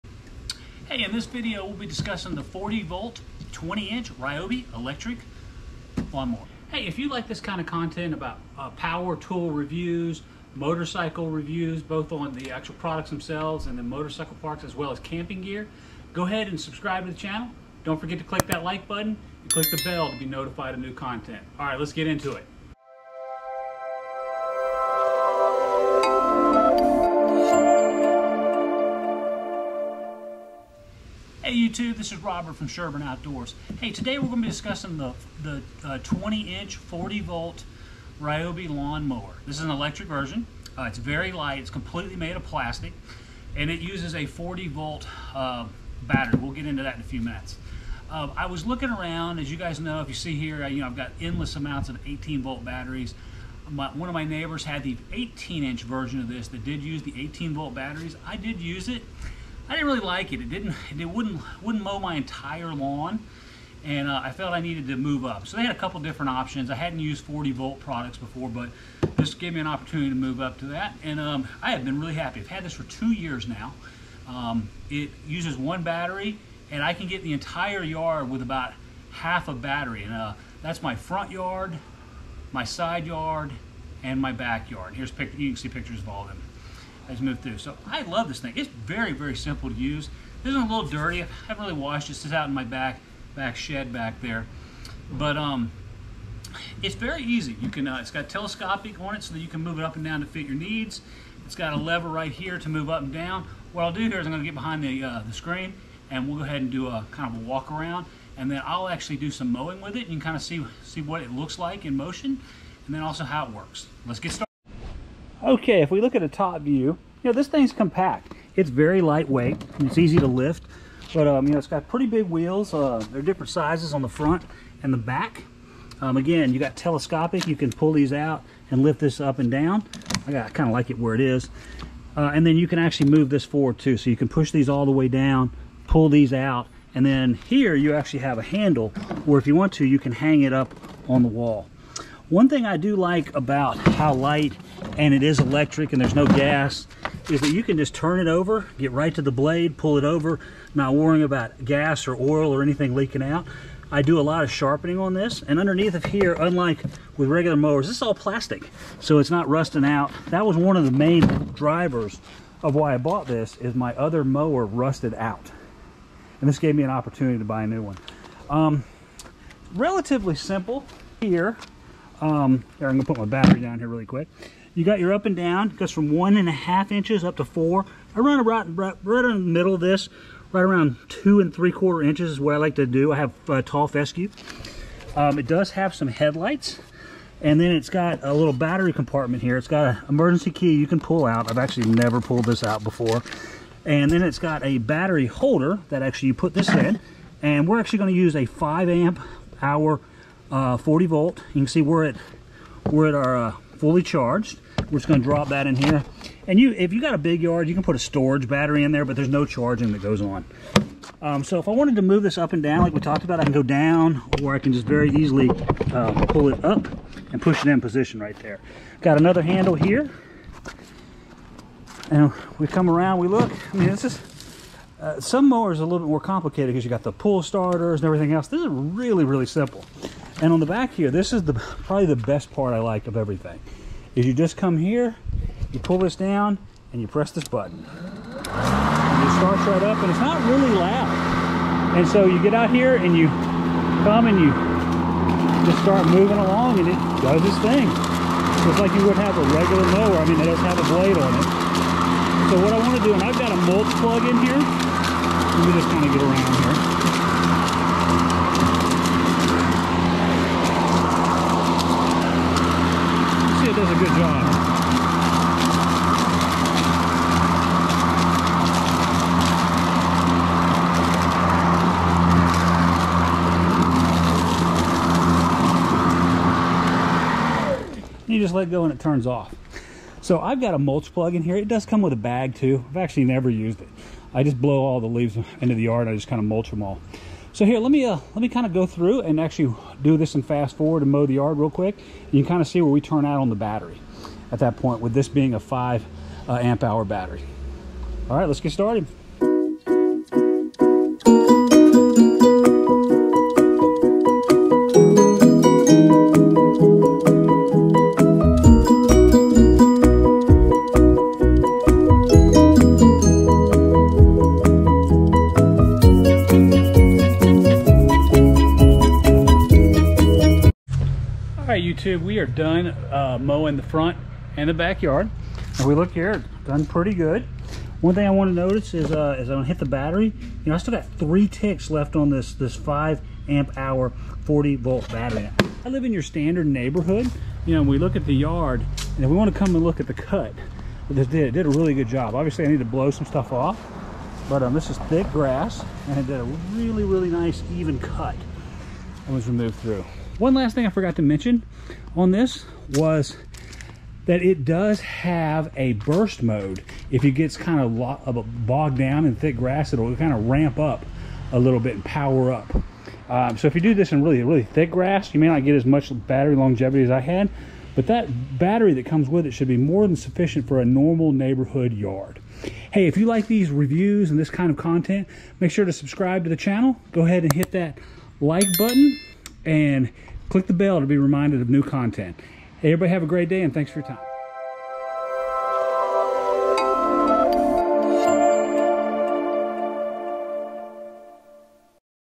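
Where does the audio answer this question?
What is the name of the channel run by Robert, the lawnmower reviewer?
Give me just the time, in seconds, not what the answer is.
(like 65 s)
32 s.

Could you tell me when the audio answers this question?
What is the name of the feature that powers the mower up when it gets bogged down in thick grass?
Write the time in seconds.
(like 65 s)
355 s.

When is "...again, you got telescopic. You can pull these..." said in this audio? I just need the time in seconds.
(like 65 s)
126 s.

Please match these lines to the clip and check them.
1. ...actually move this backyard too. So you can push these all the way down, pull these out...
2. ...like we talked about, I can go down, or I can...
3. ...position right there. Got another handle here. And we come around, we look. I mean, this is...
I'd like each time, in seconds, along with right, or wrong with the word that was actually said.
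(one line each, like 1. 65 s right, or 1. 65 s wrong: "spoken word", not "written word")
1. 132 s wrong: "forward", not "backyard"
2. 212 s right
3. 217 s right.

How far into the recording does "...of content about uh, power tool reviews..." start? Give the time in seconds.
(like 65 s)
7 s.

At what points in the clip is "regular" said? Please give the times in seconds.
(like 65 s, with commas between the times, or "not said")
157 s, 249 s.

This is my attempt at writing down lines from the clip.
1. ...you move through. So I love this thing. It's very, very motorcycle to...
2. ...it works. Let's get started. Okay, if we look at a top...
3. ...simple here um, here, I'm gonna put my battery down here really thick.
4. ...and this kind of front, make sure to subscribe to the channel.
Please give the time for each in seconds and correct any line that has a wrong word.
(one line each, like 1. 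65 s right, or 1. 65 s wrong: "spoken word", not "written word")
1. 87 s wrong: "simple", not "motorcycle"
2. 113 s right
3. 170 s wrong: "quick", not "thick"
4. 374 s wrong: "content", not "front".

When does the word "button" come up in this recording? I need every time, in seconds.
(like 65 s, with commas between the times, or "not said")
18 s, 237 s, 378 s.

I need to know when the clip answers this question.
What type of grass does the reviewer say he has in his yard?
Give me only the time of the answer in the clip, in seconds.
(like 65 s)
183 s.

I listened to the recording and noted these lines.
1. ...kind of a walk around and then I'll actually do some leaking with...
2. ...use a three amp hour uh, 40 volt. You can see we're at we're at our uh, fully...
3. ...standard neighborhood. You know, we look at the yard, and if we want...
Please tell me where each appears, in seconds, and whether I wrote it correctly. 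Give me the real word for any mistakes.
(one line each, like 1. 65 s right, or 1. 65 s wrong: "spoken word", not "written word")
1. 107 s wrong: "mowing", not "leaking"
2. 198 s wrong: "five", not "three"
3. 336 s right.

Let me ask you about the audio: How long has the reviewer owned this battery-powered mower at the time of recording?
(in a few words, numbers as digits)
2 years.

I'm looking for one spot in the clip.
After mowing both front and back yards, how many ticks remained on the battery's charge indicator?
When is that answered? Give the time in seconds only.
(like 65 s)
331 s.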